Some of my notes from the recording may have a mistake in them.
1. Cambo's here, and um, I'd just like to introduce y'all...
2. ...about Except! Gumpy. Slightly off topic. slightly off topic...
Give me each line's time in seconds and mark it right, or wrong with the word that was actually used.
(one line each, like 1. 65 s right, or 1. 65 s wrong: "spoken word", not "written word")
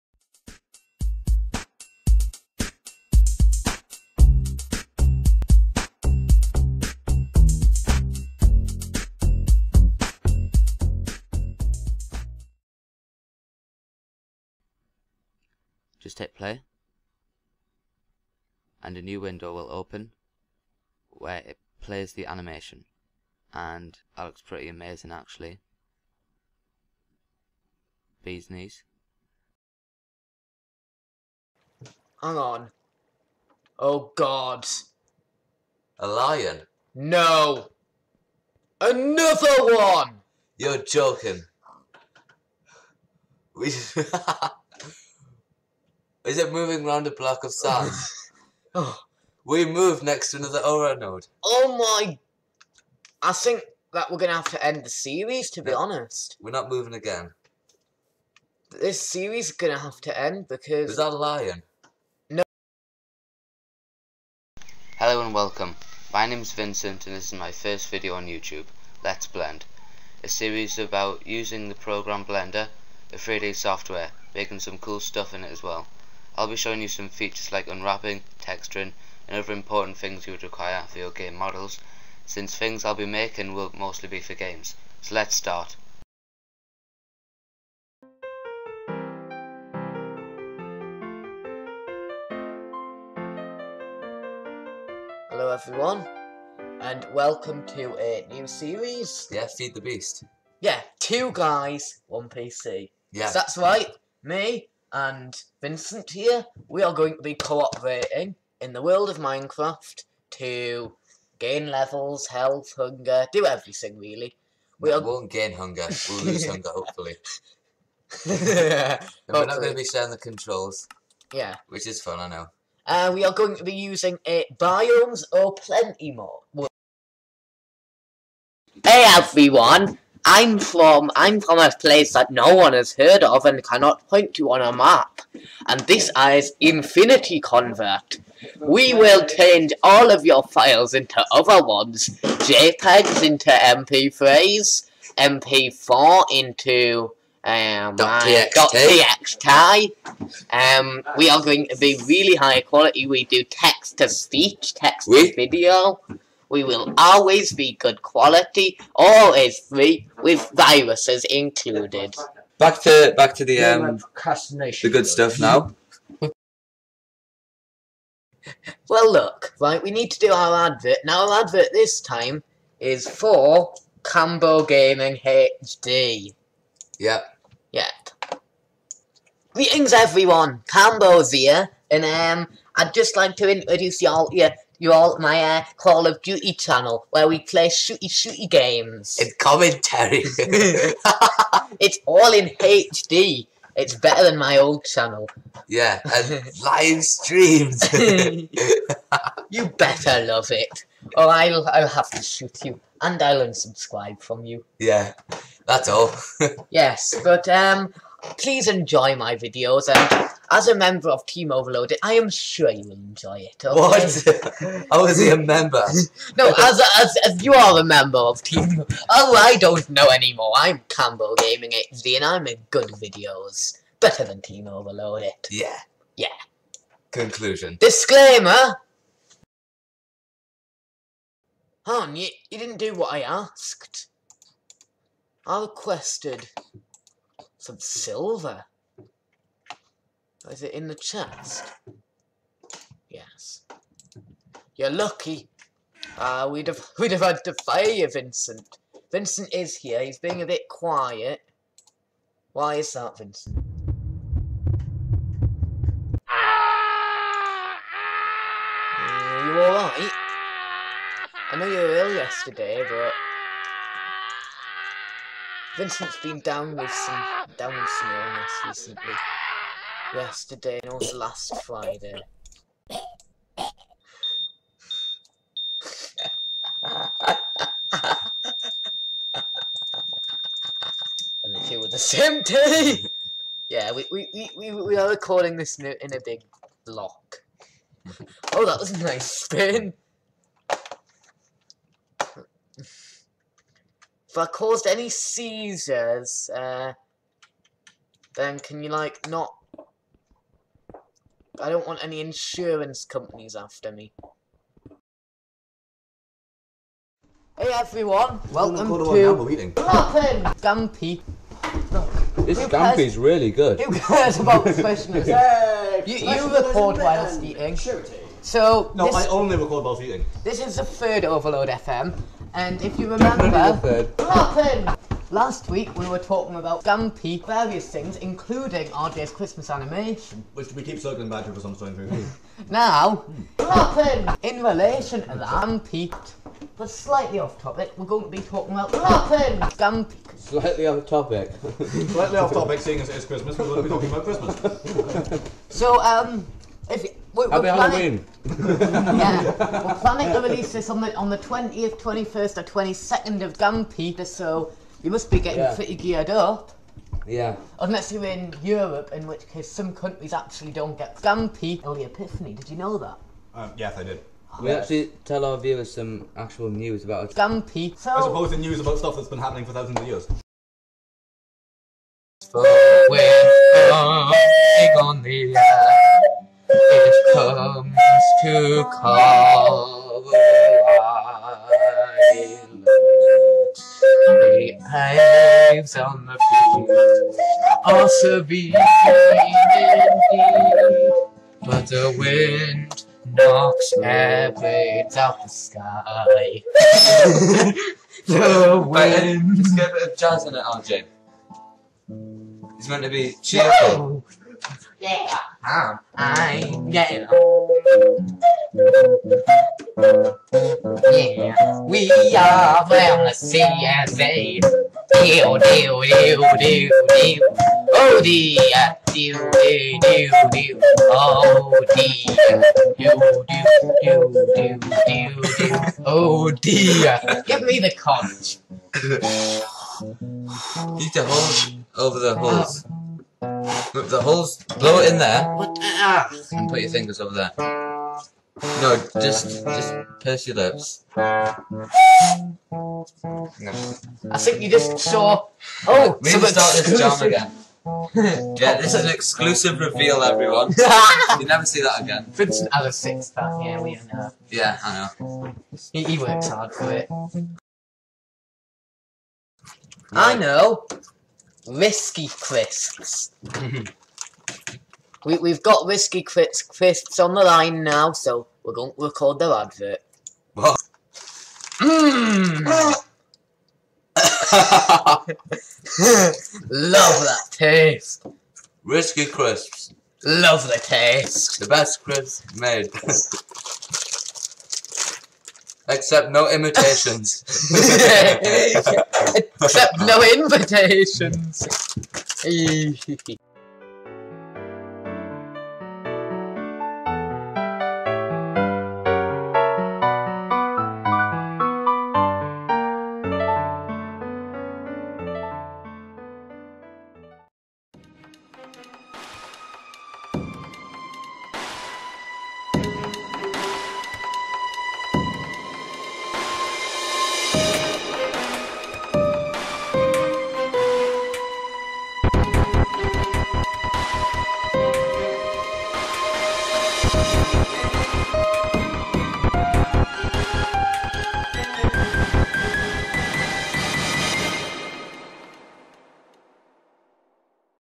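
1. 180 s right
2. 338 s wrong: "Martin", not "Except".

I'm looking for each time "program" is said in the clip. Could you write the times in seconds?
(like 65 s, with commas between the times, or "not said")
71 s.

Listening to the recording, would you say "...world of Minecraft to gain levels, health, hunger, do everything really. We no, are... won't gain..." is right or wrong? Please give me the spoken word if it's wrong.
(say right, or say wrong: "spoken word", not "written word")
right.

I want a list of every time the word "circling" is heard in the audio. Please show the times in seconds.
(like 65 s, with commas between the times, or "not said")
330 s.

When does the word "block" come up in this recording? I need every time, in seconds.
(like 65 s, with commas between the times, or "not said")
47 s, 286 s.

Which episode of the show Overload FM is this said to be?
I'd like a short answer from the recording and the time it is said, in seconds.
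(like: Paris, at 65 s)
Third, at 320 s.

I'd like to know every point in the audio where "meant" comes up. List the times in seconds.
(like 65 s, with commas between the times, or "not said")
402 s.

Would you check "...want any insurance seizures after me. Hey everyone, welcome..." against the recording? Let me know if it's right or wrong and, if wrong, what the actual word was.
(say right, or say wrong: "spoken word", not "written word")
wrong: "companies", not "seizures".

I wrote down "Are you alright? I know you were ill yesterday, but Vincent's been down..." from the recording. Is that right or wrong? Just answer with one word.
right.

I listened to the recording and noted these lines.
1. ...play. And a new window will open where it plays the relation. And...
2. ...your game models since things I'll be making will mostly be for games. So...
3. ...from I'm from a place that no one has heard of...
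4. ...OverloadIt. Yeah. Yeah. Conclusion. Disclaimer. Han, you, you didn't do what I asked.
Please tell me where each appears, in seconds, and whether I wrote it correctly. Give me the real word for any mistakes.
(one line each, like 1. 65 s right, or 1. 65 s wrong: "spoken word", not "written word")
1. 16 s wrong: "animation", not "relation"
2. 80 s right
3. 130 s right
4. 224 s right.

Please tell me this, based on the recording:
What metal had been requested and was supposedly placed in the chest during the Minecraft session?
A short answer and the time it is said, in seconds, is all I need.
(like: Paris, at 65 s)
Silver, at 237 s.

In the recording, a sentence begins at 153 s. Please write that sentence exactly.
We do text to speech, text to video.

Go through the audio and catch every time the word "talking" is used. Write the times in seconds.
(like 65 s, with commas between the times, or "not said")
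326 s, 338 s, 343 s.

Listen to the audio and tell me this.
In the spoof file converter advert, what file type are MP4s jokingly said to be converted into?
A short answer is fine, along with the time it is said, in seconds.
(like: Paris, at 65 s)
.txt, at 147 s.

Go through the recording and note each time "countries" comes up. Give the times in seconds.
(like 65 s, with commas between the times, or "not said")
359 s.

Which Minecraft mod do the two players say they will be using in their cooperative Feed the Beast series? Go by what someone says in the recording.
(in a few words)
Biomes O' Plenty.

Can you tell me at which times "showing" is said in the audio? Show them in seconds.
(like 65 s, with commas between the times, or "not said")
76 s.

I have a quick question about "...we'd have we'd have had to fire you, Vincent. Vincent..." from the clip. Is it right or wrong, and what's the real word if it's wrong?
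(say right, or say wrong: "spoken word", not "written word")
right.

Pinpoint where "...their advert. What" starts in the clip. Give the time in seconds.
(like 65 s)
469 s.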